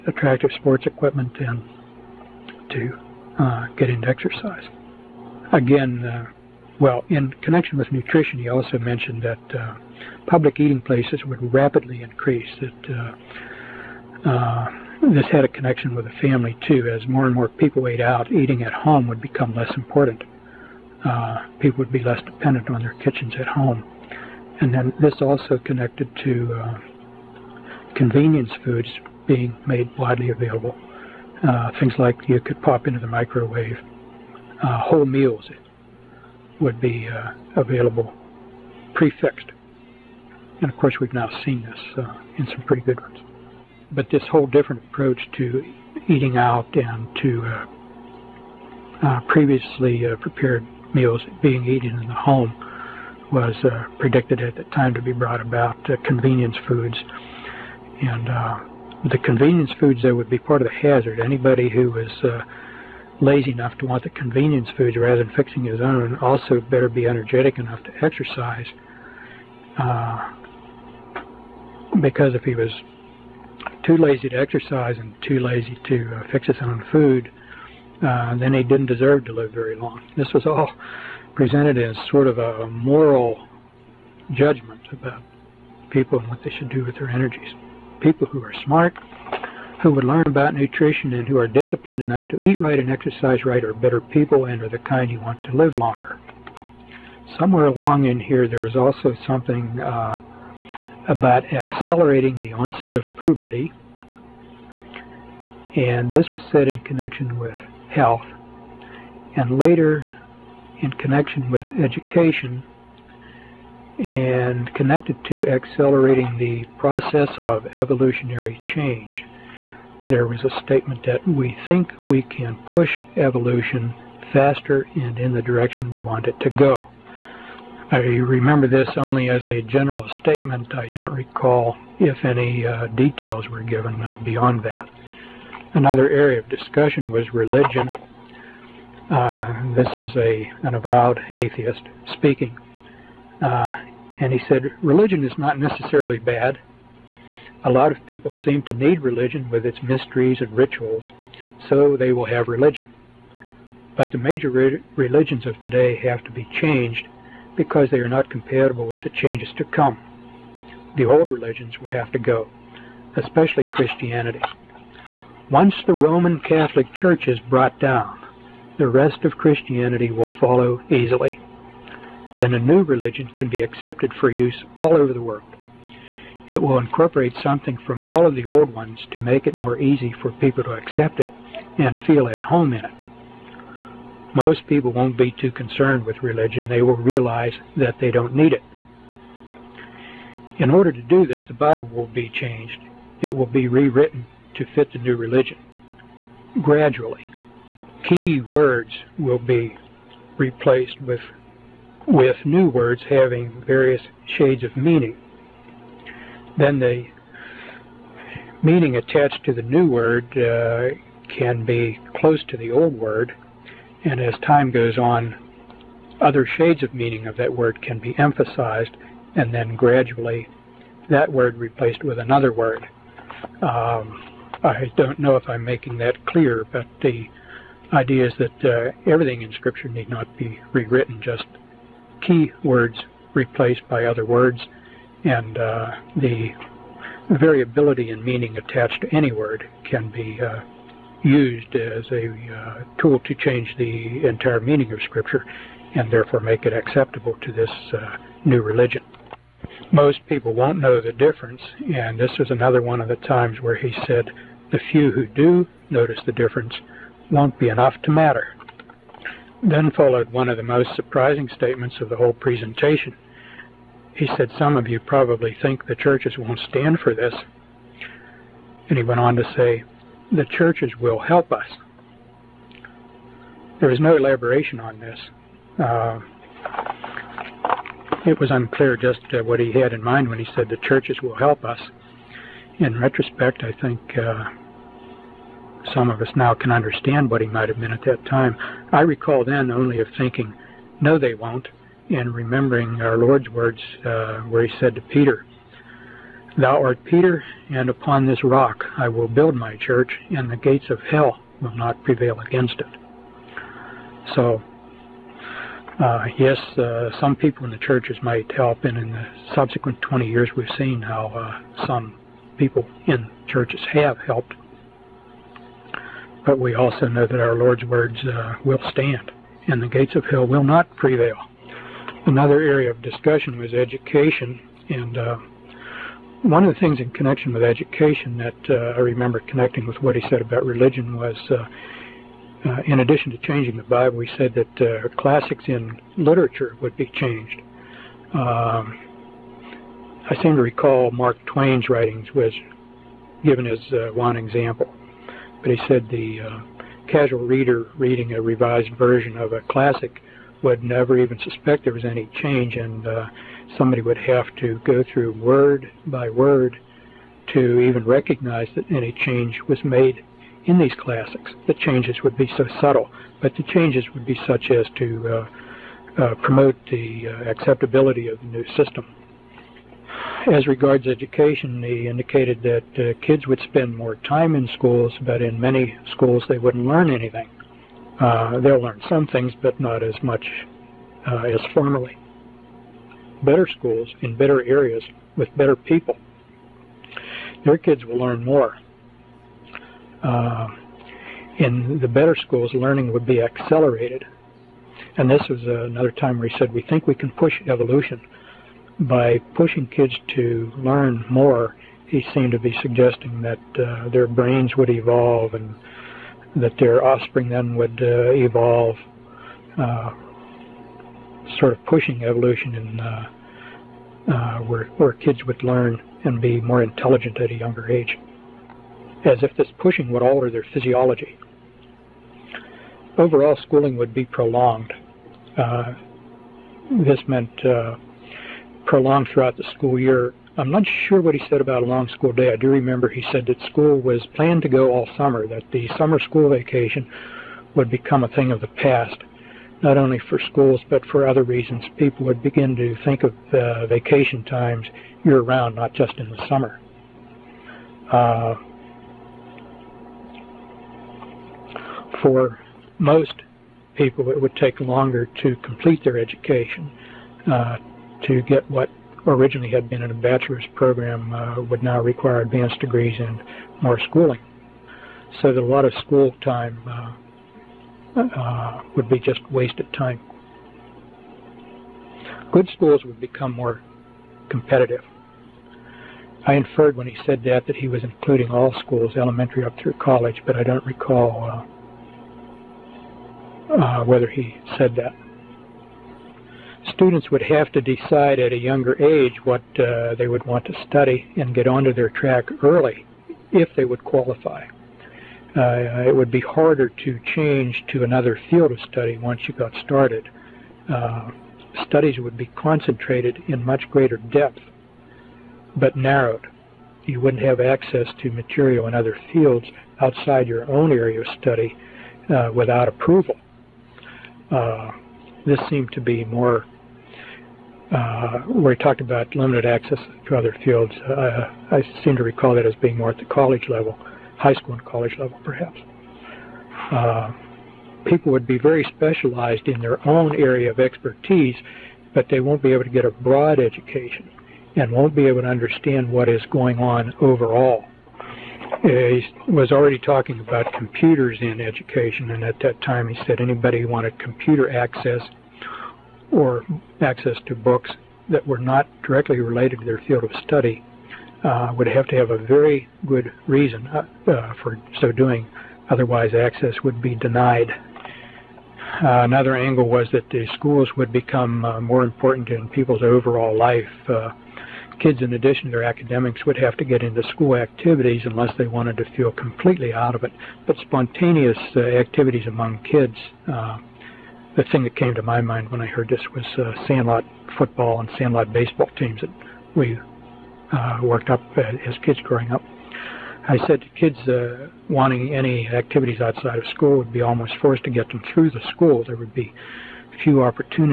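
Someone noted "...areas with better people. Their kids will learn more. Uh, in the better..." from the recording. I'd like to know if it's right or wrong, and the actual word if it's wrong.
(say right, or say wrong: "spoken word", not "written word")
right.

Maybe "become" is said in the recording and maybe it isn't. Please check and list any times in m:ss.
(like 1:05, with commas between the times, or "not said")
0:19, 7:17, 7:53, 9:21.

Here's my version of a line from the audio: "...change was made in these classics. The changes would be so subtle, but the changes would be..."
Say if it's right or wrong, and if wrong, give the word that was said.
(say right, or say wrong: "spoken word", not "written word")
right.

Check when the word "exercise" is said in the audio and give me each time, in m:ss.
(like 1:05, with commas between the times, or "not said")
0:04, 1:08, 1:14, 1:32.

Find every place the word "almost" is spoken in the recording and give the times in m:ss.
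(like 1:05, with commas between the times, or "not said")
9:47.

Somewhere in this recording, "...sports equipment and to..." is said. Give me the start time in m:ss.
0:00.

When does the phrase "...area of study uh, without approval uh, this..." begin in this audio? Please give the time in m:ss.
8:30.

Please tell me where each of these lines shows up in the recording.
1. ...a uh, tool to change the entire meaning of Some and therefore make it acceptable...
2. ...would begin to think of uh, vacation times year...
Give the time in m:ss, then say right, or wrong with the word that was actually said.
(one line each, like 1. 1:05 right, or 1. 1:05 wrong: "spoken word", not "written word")
1. 4:02 wrong: "Scripture", not "Some"
2. 7:22 right.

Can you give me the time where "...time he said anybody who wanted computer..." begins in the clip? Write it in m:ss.
9:02.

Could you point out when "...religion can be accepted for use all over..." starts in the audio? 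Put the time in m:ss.
2:52.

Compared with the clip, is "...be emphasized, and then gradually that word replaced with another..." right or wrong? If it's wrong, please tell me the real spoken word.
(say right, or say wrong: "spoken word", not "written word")
right.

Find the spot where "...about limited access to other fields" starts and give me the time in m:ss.
8:39.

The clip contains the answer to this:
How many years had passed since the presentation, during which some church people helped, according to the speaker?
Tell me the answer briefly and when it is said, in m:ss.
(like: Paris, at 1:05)
20, at 5:10.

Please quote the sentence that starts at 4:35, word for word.
Uh, it was unclear just uh, what he had in mind when he said the churches will help us.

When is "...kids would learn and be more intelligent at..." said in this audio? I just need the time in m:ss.
6:55.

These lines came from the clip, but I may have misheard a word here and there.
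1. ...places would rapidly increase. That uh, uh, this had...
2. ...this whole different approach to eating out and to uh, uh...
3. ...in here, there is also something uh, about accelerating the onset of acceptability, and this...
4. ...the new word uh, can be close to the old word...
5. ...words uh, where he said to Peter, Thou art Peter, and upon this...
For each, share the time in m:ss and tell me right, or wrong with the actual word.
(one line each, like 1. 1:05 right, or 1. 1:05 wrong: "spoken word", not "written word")
1. 0:10 right
2. 0:44 right
3. 1:38 wrong: "puberty", not "acceptability"
4. 3:29 right
5. 4:53 right.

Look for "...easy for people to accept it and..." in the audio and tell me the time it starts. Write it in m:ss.
2:59.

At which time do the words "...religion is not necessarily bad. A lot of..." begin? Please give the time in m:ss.
2:24.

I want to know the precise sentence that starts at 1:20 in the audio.
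This was all presented as sort of a moral judgment about people and what they should do with their energies.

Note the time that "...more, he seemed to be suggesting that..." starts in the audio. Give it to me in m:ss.
6:41.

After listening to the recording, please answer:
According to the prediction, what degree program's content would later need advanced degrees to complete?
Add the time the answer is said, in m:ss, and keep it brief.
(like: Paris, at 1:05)
bachelor's, at 7:40.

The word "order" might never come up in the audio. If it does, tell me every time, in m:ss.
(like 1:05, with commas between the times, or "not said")
3:10.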